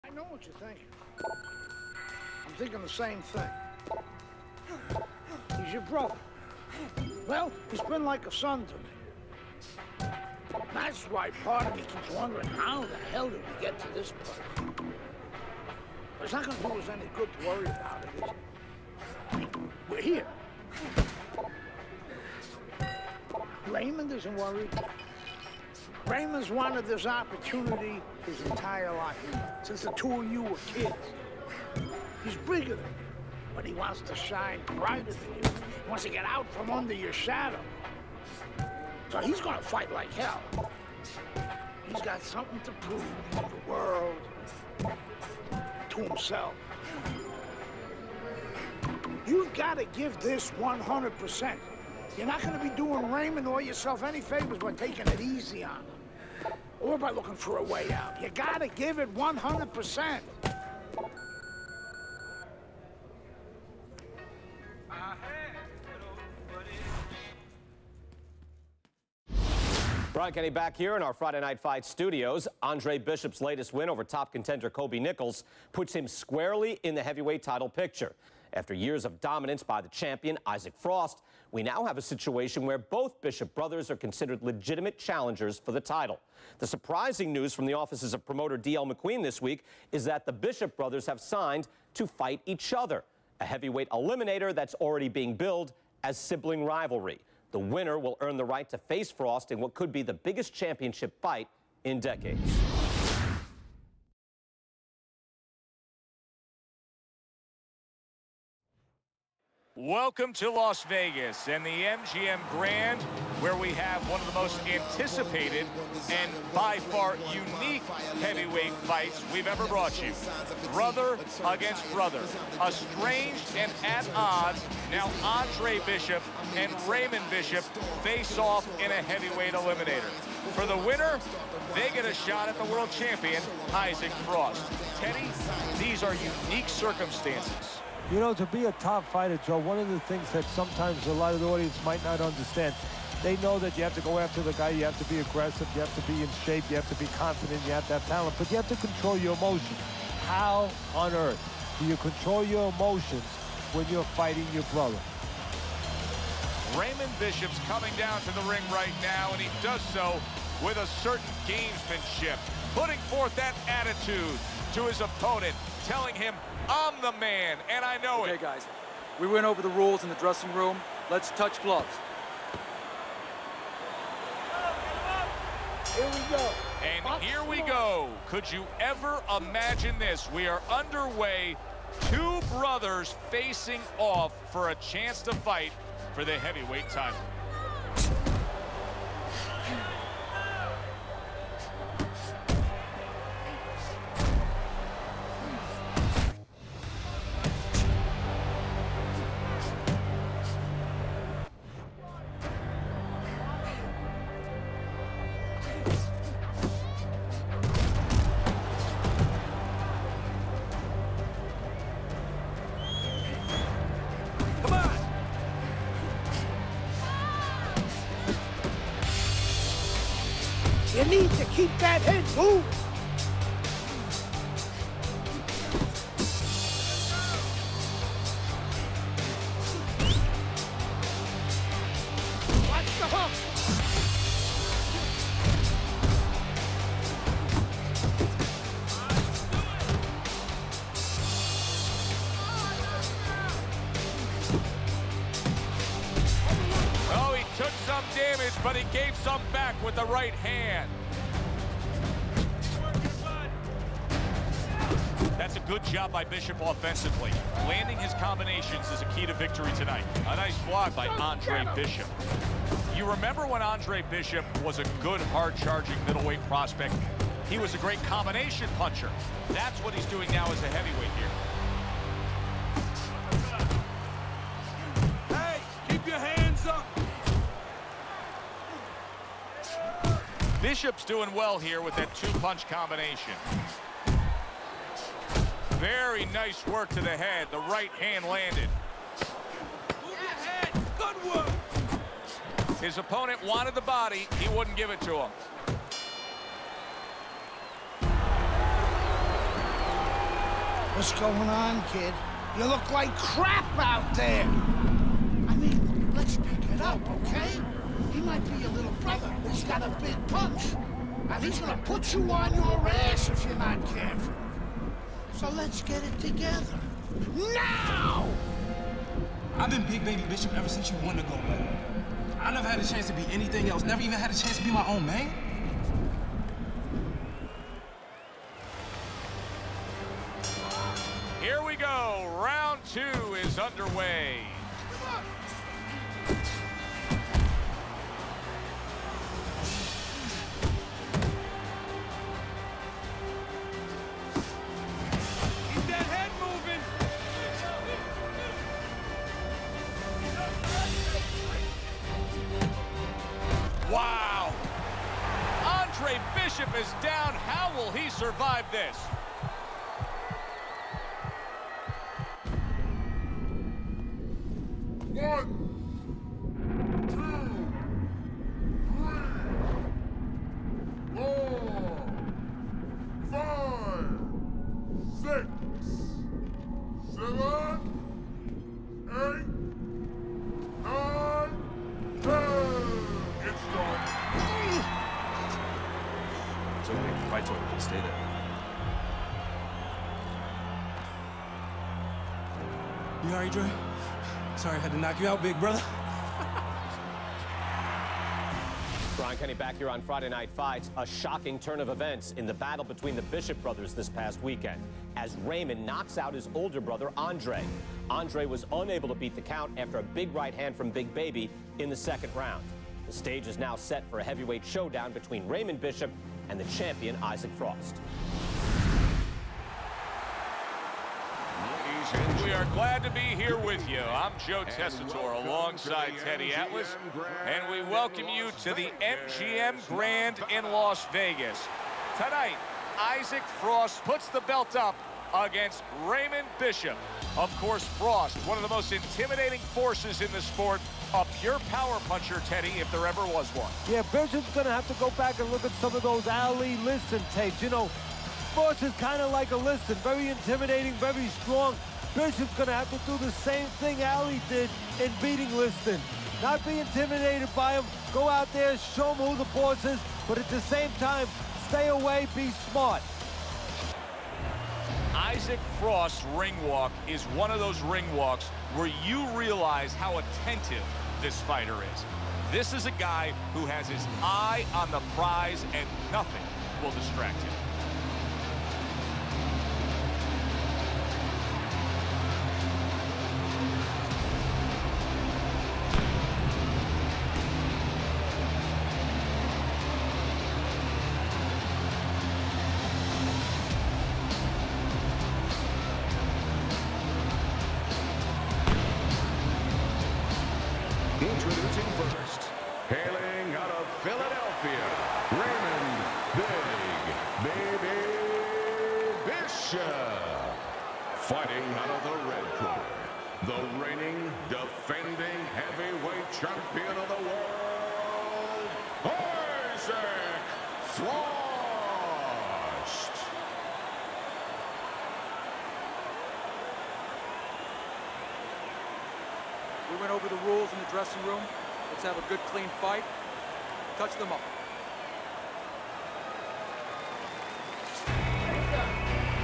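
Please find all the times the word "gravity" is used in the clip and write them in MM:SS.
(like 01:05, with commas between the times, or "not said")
not said.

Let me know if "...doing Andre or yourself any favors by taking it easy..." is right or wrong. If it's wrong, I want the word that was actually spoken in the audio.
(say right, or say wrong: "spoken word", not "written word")
wrong: "Raymond", not "Andre".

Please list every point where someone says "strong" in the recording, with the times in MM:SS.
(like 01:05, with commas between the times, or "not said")
07:31.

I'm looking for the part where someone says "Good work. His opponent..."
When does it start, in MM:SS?
04:50.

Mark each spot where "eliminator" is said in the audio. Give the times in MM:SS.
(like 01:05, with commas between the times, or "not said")
01:33, 02:09.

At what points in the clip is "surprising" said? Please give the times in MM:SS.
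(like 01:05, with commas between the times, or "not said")
01:26.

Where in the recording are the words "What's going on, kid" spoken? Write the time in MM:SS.
05:00.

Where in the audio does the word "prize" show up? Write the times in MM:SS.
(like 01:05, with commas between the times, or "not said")
07:55.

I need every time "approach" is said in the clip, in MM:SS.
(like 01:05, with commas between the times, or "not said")
not said.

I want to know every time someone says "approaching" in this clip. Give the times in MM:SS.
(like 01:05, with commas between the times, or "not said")
not said.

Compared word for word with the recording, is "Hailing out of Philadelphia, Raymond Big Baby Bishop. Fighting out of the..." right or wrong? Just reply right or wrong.
right.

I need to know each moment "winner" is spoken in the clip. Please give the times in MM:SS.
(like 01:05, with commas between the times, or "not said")
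01:37, 02:10.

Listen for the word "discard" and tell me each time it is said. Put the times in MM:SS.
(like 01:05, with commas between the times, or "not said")
not said.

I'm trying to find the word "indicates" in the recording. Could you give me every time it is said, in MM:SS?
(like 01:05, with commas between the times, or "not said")
not said.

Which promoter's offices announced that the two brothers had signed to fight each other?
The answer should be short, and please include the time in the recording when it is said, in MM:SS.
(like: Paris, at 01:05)
D.L. McQueen, at 01:28.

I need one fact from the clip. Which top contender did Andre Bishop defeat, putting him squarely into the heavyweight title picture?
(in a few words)
Kobe Nichols.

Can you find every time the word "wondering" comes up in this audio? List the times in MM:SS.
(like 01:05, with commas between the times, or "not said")
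00:12.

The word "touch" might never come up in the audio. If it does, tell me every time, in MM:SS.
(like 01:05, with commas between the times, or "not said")
02:51, 08:53.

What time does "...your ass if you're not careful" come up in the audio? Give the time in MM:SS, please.
05:12.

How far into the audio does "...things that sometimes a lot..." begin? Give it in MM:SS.
02:20.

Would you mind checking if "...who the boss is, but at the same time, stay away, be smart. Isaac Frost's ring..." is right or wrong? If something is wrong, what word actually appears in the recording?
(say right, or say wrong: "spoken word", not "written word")
right.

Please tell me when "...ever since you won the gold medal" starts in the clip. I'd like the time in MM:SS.
05:20.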